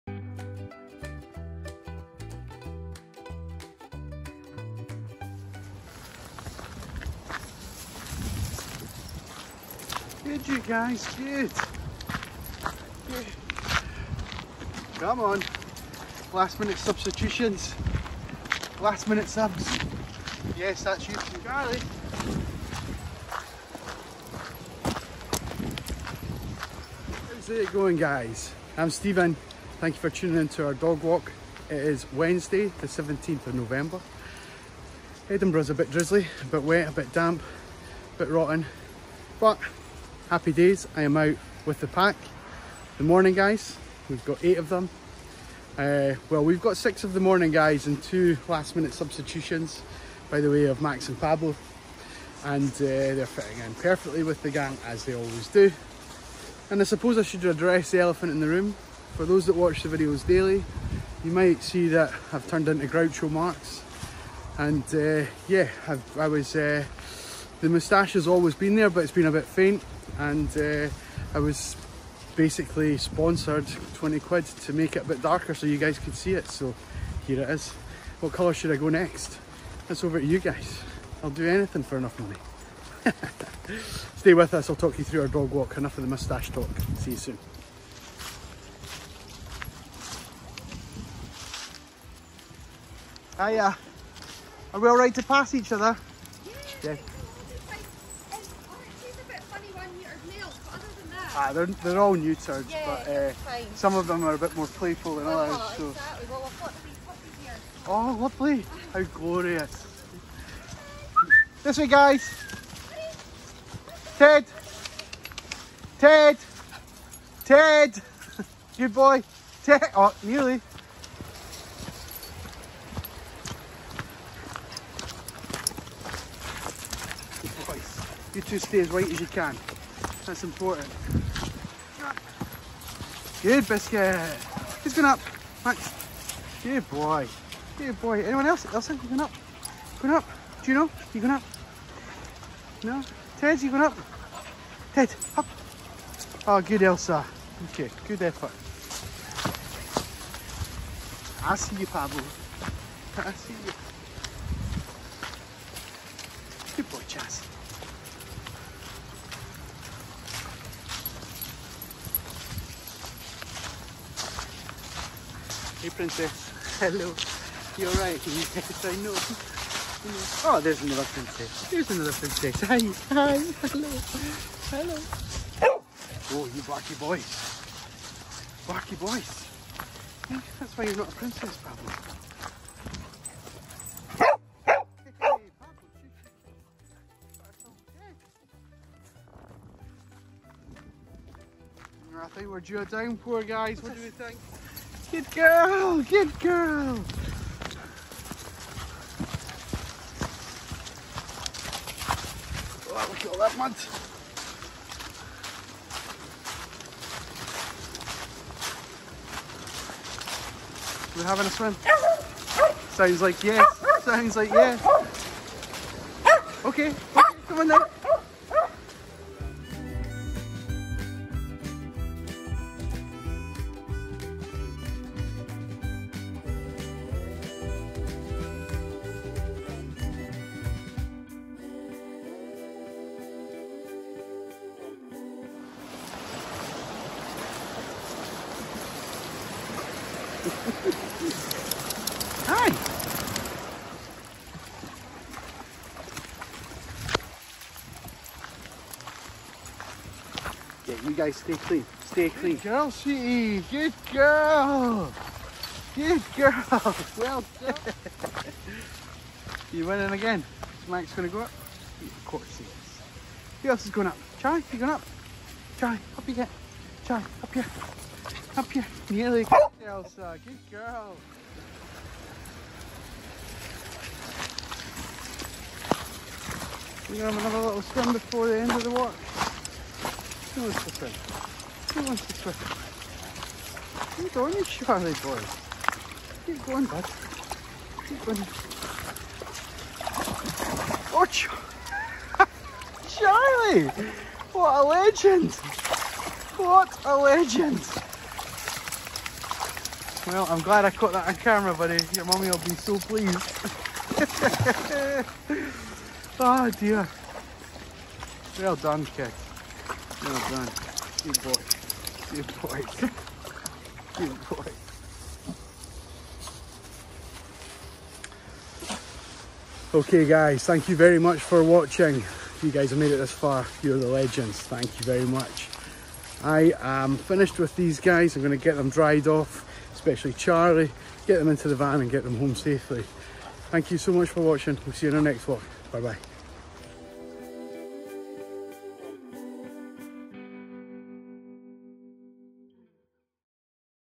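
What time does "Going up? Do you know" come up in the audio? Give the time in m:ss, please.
2:19.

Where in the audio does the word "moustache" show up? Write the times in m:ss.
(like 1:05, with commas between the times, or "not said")
1:07, 1:26.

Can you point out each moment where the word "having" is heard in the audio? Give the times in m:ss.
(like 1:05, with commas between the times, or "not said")
3:31.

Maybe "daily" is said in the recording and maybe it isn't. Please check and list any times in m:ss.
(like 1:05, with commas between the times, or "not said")
1:00.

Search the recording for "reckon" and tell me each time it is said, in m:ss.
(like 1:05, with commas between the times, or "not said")
not said.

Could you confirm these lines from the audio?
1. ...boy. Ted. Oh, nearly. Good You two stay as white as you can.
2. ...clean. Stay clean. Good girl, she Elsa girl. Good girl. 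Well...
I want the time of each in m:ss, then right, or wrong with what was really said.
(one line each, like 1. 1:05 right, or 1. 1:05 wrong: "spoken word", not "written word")
1. 1:58 right
2. 4:11 wrong: "Good", not "Elsa".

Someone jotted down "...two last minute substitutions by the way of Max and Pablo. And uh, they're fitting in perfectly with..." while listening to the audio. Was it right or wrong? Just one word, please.
right.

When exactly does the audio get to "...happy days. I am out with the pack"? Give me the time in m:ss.
0:40.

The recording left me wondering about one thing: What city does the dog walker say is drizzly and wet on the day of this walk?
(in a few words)
Edinburgh.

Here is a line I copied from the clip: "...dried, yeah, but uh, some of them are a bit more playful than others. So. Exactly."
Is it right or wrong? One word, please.
wrong.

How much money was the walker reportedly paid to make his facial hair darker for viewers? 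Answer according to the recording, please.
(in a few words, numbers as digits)
20 quid.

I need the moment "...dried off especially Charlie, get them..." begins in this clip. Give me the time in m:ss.
5:28.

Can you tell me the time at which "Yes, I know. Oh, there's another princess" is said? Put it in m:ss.
2:48.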